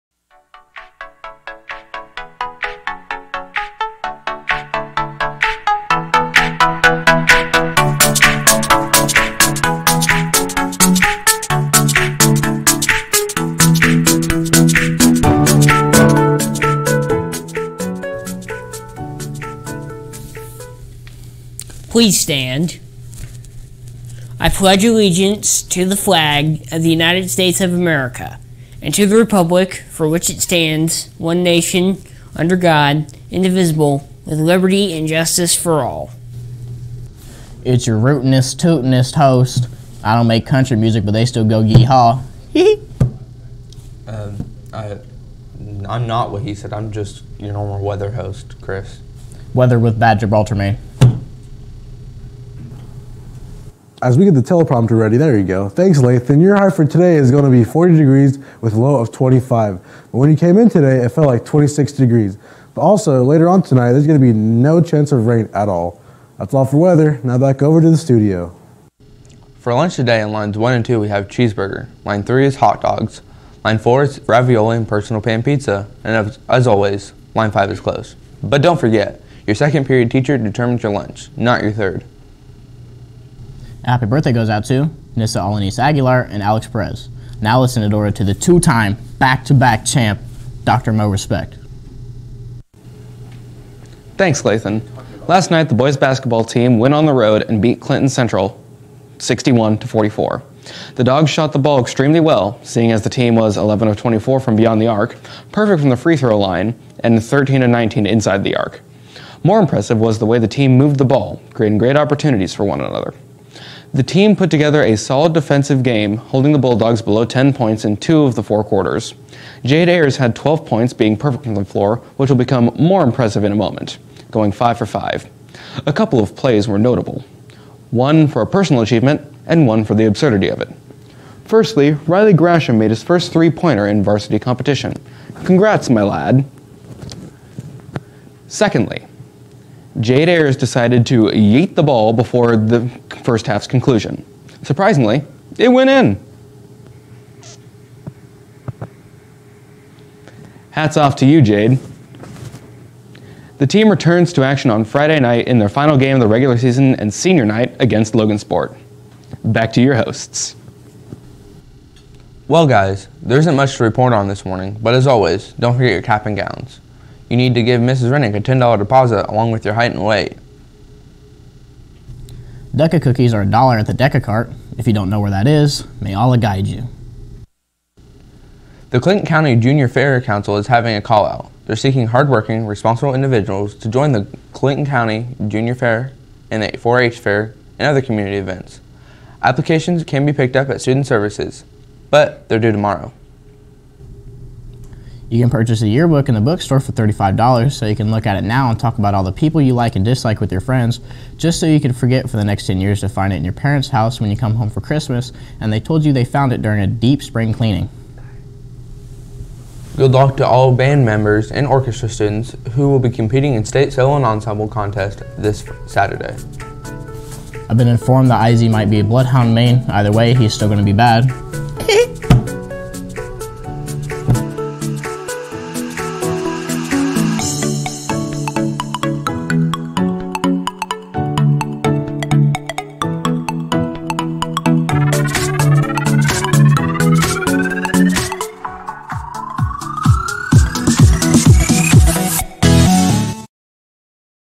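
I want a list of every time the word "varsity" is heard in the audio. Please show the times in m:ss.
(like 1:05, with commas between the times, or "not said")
2:14.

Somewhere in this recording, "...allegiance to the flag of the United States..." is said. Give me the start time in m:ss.
0:24.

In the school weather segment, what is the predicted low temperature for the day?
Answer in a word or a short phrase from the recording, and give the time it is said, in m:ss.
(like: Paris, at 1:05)
25, at 0:59.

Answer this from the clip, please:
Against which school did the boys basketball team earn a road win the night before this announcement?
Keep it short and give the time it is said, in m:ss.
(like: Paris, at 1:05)
Clinton Central, at 1:37.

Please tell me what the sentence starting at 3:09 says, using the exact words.
Applications can be picked up at Student Services, but they're due tomorrow.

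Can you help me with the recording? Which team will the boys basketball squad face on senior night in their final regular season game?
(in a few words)
Logansport.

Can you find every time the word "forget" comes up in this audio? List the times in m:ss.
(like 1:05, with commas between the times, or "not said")
1:18, 2:45, 3:21.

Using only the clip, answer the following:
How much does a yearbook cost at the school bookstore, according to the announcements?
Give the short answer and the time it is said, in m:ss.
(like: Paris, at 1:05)
$35, at 3:16.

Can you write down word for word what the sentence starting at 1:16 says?
And as always, line 5 is closed.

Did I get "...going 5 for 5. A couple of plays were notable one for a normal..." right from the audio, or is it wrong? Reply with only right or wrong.
wrong.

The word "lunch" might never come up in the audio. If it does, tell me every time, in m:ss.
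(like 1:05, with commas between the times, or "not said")
1:09, 1:20.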